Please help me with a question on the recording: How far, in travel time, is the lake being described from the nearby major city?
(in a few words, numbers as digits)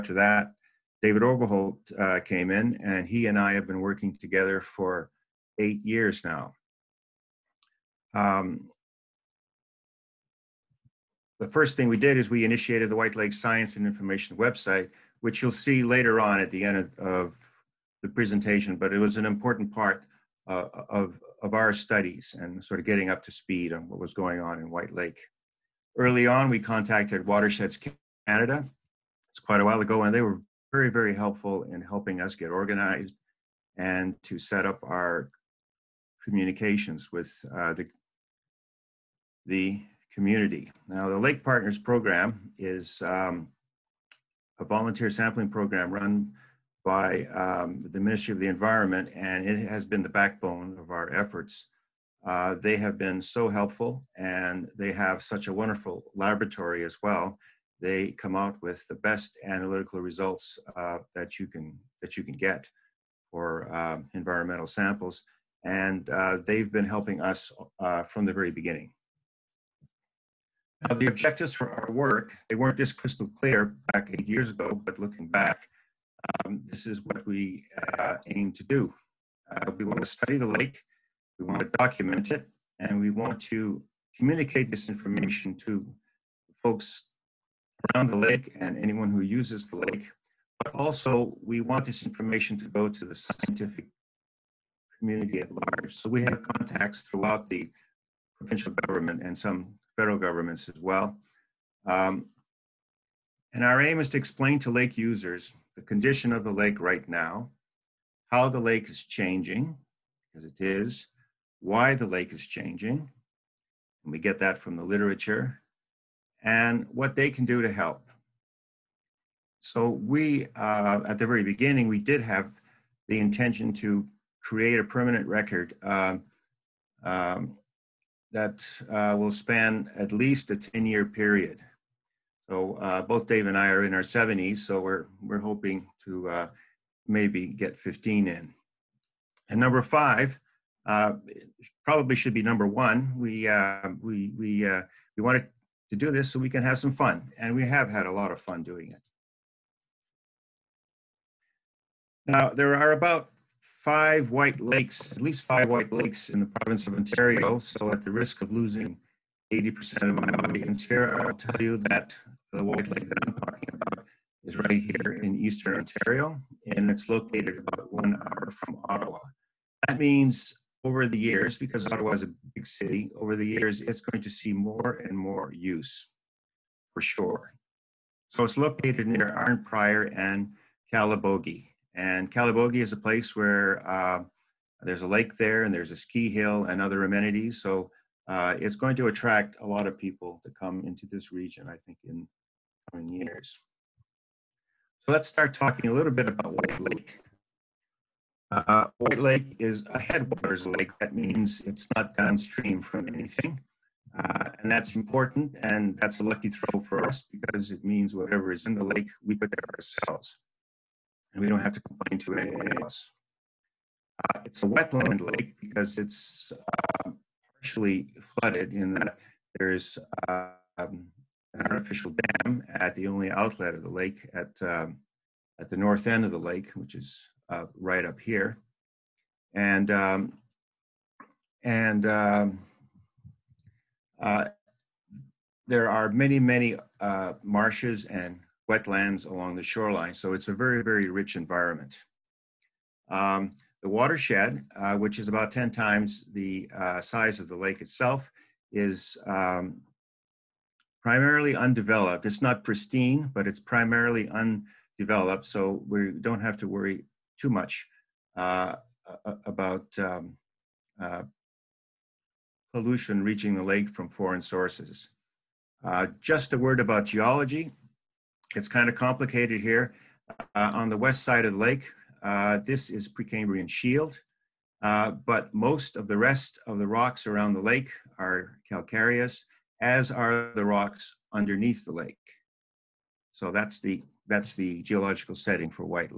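1 hour.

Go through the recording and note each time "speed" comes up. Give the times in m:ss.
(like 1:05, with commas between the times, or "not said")
0:23.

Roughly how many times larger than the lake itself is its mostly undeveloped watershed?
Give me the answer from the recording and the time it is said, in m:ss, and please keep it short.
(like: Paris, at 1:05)
10 times, at 4:05.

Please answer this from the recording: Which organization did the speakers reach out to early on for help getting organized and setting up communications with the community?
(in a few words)
Watersheds Canada.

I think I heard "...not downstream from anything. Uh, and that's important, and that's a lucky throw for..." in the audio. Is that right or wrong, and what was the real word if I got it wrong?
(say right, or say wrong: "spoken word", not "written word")
right.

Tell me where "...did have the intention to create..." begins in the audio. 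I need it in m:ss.
2:01.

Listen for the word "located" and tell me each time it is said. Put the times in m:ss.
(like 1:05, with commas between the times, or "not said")
2:47, 2:58.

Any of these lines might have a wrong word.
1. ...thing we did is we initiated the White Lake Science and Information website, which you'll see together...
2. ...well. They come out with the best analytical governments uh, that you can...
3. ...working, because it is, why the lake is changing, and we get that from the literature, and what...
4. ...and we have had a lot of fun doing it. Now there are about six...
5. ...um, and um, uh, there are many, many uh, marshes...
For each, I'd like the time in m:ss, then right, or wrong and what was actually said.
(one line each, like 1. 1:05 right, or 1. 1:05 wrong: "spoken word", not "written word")
1. 0:11 wrong: "later", not "together"
2. 0:57 wrong: "results", not "governments"
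3. 1:49 wrong: "changing", not "working"
4. 2:27 wrong: "five", not "six"
5. 3:49 right.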